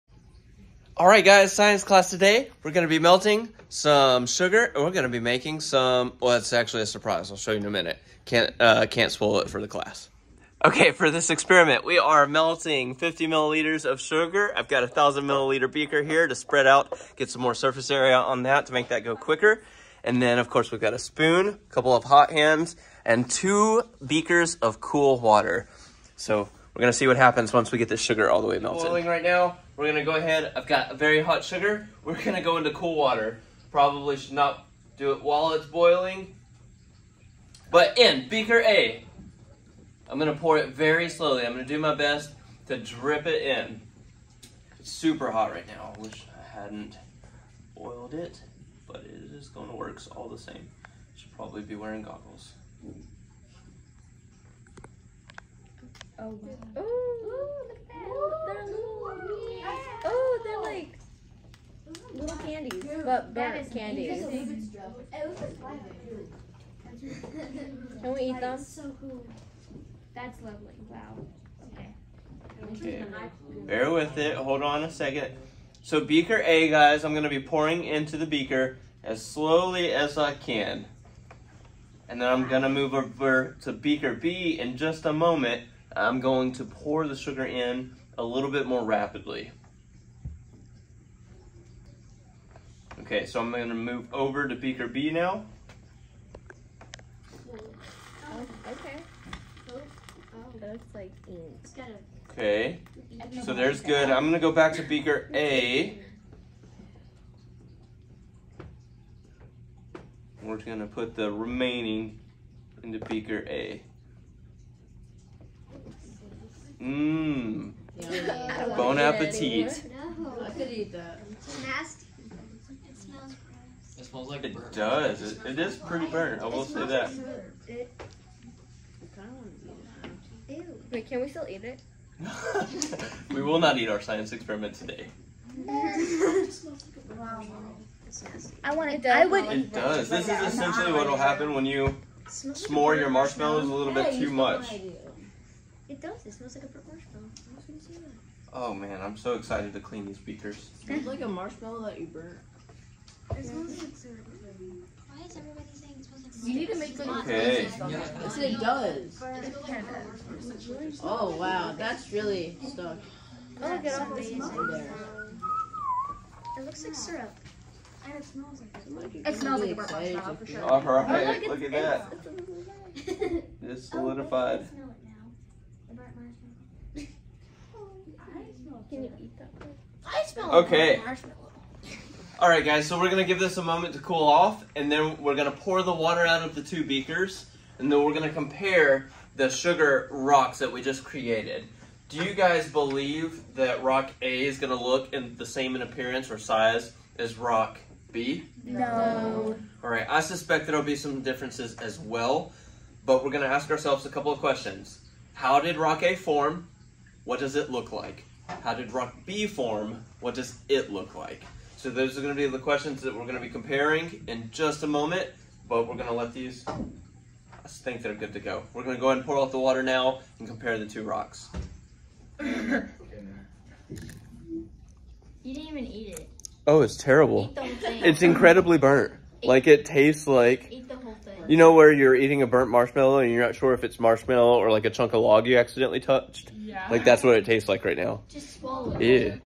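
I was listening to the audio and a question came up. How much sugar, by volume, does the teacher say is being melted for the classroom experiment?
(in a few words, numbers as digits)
50 milliliters.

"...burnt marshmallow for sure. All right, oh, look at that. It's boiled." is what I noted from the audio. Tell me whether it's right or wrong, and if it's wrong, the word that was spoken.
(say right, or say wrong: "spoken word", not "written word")
wrong: "solidified", not "boiled".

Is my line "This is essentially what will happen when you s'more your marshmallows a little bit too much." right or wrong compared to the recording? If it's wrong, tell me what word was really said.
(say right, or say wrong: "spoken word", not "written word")
right.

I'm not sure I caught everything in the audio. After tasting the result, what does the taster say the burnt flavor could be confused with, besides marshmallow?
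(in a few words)
a chunk of log.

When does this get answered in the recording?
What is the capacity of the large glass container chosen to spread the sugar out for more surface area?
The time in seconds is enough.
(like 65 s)
14 s.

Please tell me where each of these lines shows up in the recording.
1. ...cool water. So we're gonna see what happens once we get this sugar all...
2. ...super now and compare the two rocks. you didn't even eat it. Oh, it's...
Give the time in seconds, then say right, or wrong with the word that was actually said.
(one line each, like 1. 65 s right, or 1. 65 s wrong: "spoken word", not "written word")
1. 24 s right
2. 219 s wrong: "water", not "super".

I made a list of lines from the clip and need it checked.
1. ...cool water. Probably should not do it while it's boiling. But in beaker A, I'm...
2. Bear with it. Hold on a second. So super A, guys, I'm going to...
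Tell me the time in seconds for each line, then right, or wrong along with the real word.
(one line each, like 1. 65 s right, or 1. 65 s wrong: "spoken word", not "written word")
1. 32 s right
2. 73 s wrong: "beaker", not "super".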